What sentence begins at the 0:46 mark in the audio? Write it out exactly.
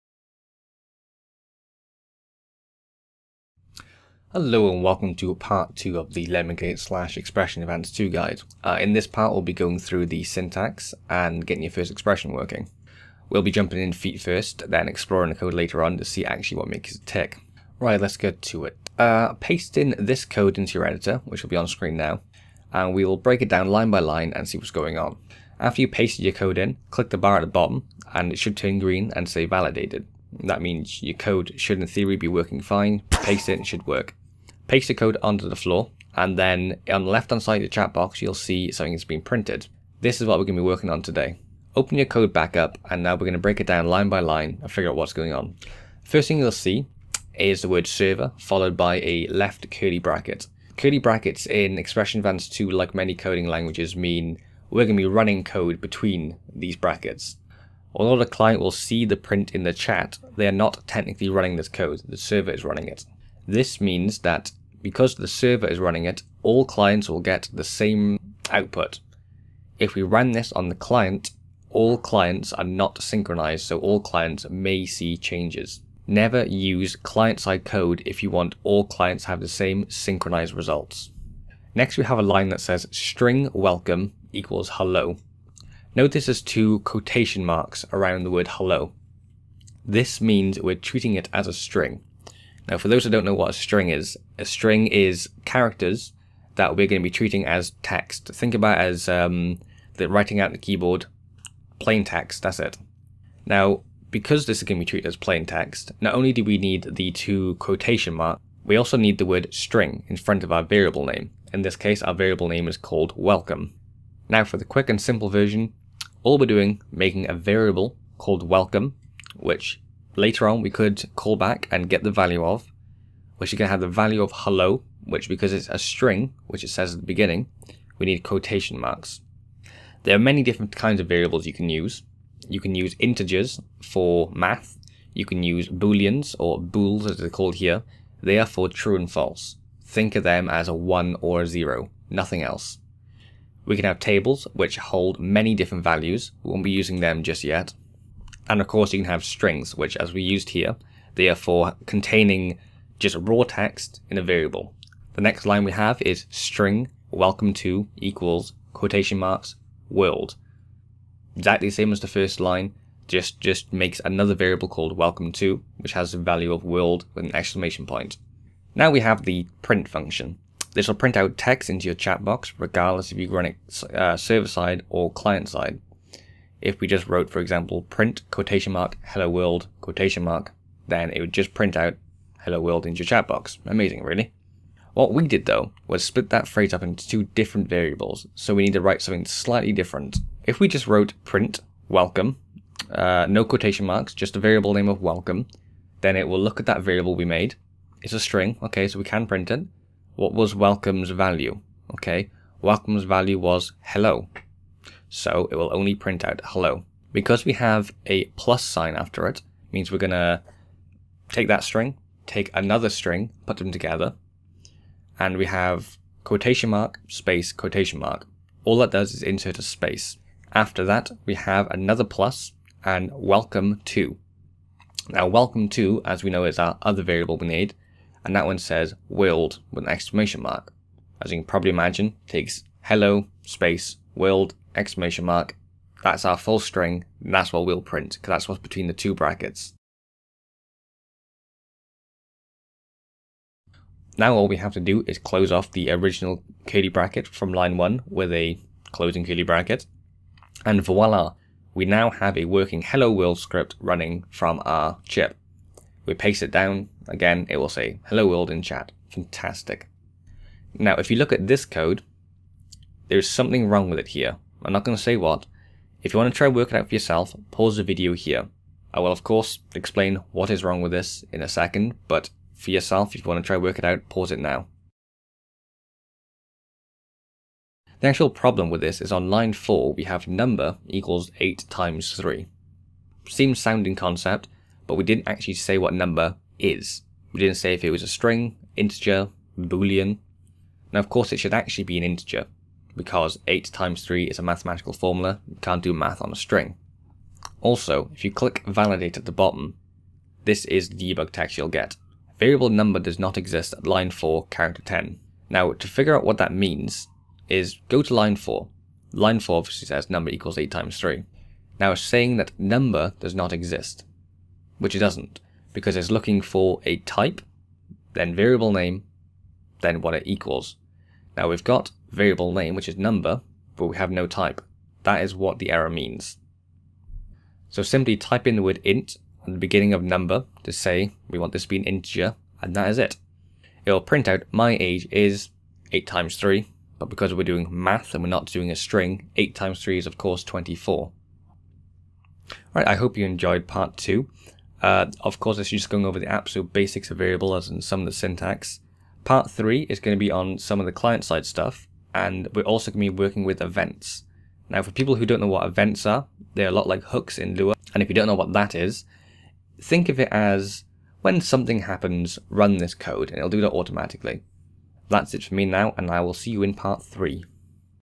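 First thing you'll see is the word server, followed by a left curly bracket.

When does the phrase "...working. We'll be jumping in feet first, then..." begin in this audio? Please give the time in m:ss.
0:12.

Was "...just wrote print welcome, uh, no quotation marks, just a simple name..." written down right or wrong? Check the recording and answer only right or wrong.
wrong.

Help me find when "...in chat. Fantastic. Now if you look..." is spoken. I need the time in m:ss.
4:18.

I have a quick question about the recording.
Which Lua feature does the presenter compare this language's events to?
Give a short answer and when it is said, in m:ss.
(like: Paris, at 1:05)
hooks, at 5:57.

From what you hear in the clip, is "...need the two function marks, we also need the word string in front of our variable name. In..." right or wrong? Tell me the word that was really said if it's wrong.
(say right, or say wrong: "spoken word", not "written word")
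wrong: "quotation", not "function".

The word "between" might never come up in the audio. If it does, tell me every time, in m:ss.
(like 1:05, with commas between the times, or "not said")
0:55, 3:58.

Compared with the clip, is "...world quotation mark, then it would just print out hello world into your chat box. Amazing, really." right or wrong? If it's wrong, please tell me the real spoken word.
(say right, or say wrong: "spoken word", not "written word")
right.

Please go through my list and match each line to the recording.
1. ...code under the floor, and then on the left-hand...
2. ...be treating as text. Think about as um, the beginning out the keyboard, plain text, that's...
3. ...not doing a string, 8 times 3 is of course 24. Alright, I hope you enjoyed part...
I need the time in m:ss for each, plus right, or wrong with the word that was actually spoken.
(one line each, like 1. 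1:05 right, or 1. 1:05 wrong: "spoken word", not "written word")
1. 0:34 right
2. 1:37 wrong: "writing", not "beginning"
3. 5:38 right.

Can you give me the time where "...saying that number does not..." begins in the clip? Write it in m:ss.
5:12.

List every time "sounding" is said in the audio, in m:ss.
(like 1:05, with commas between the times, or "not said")
4:43.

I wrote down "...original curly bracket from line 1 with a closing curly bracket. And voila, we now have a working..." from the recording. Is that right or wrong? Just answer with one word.
right.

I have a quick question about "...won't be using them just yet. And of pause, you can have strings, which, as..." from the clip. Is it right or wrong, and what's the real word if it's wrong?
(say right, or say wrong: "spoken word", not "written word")
wrong: "course", not "pause".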